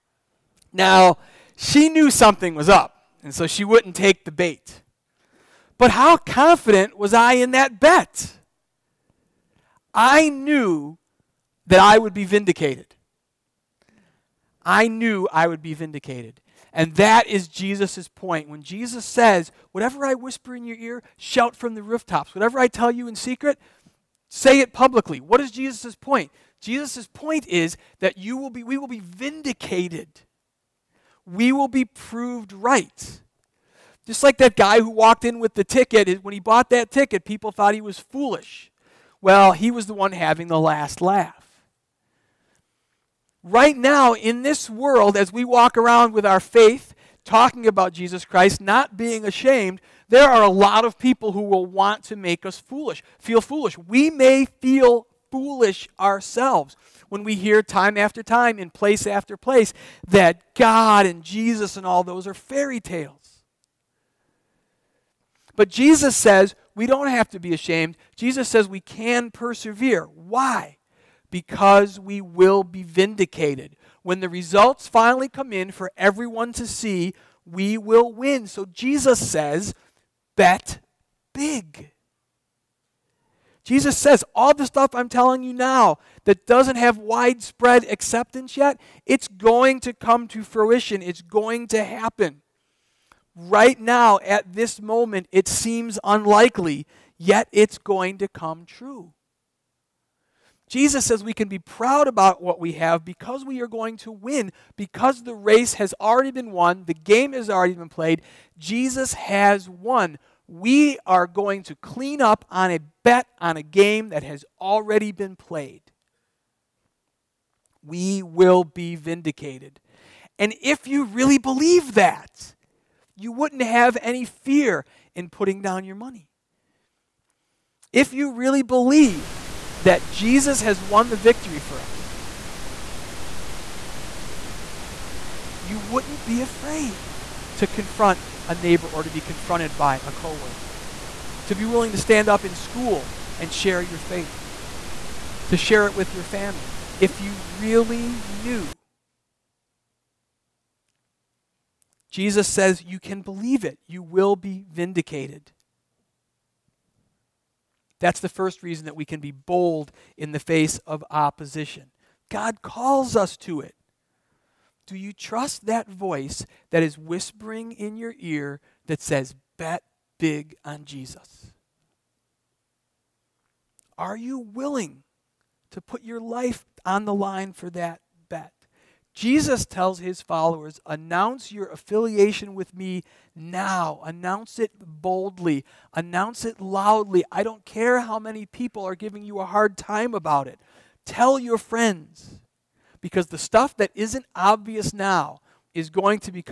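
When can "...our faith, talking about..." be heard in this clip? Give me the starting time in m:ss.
0:46.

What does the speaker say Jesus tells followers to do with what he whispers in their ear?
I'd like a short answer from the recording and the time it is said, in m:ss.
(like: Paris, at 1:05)
Shout from the rooftops, at 0:21.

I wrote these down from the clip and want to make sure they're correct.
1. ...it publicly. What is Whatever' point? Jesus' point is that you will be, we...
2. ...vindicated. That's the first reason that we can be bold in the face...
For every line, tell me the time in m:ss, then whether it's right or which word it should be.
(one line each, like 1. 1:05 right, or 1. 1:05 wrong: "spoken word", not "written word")
1. 0:24 wrong: "Jesus", not "Whatever"
2. 2:34 right.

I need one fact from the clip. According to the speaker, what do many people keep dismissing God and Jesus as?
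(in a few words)
Fairy tales.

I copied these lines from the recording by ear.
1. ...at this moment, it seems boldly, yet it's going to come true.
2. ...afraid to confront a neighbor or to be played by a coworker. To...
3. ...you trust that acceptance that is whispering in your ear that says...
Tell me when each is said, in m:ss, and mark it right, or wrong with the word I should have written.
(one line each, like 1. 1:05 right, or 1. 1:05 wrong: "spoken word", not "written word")
1. 1:34 wrong: "unlikely", not "boldly"
2. 2:16 wrong: "confronted", not "played"
3. 2:44 wrong: "voice", not "acceptance".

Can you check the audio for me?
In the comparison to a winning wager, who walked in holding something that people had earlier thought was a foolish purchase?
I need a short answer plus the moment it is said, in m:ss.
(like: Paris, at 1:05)
That guy, at 0:34.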